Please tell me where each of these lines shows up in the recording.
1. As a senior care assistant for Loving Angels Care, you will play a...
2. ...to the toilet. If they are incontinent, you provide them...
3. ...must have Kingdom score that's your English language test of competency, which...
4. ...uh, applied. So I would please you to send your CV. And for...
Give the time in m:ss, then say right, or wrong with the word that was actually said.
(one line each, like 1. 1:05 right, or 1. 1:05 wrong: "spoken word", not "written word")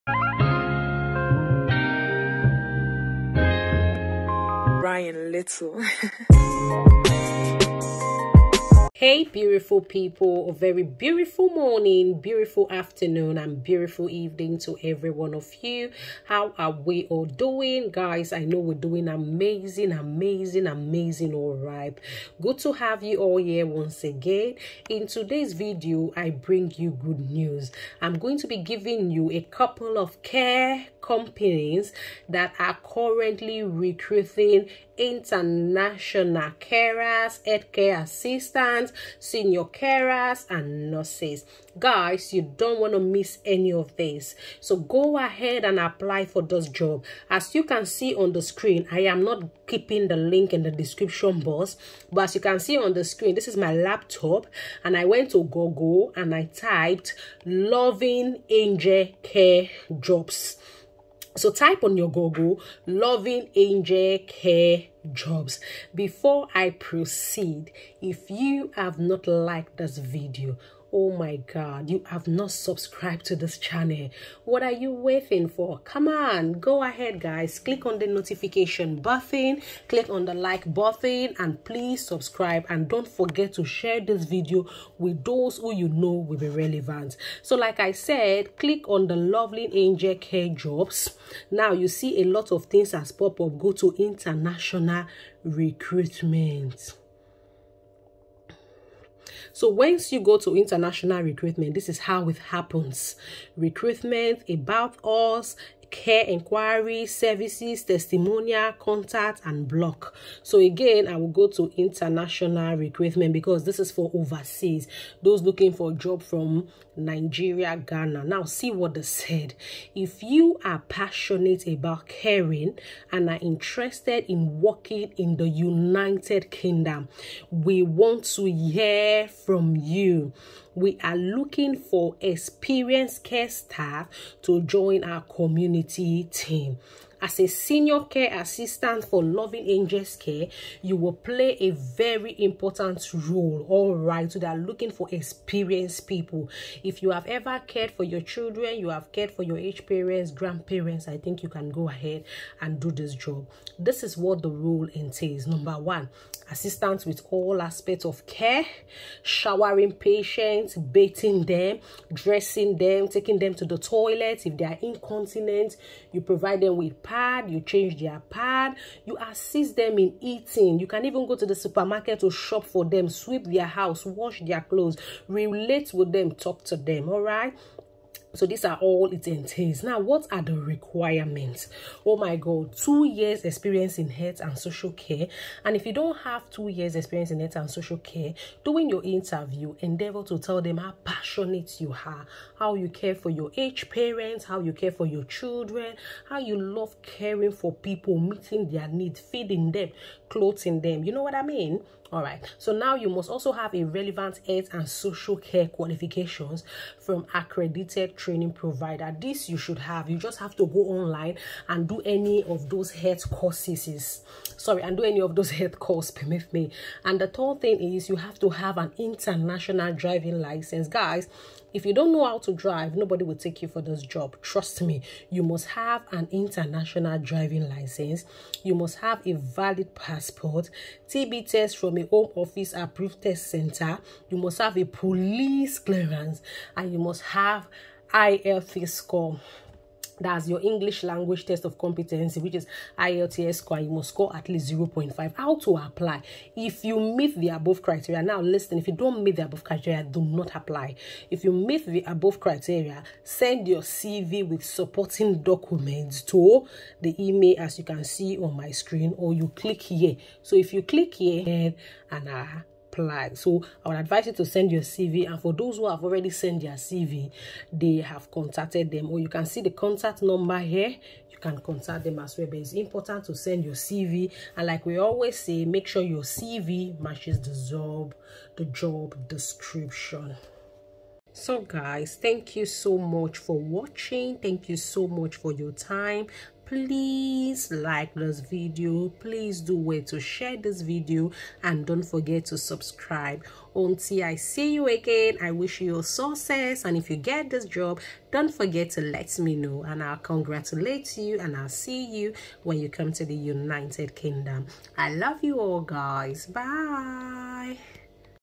1. 2:17 right
2. 2:43 right
3. 3:56 wrong: "IFA", not "Kingdom"
4. 4:22 wrong: "advise", not "please".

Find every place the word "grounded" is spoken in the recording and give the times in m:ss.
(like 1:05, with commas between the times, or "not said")
not said.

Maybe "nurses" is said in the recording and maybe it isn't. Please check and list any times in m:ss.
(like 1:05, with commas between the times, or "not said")
0:40.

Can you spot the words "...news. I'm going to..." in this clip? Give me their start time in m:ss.
0:27.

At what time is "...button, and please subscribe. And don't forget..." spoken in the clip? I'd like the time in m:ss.
1:20.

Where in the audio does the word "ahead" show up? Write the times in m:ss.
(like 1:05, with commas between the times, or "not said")
0:45, 1:16, 2:31.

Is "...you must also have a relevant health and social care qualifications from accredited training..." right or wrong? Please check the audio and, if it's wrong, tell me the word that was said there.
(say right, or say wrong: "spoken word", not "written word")
right.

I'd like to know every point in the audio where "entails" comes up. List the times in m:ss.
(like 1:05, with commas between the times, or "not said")
2:34, 2:59.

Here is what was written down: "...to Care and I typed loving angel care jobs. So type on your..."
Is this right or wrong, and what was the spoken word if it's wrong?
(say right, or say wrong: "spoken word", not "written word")
wrong: "Google", not "Care".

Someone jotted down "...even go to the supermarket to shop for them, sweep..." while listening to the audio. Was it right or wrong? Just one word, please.
right.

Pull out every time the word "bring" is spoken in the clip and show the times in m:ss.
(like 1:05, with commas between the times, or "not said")
0:26.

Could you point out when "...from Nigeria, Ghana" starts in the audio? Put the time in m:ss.
1:56.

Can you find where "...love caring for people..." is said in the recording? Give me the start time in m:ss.
3:16.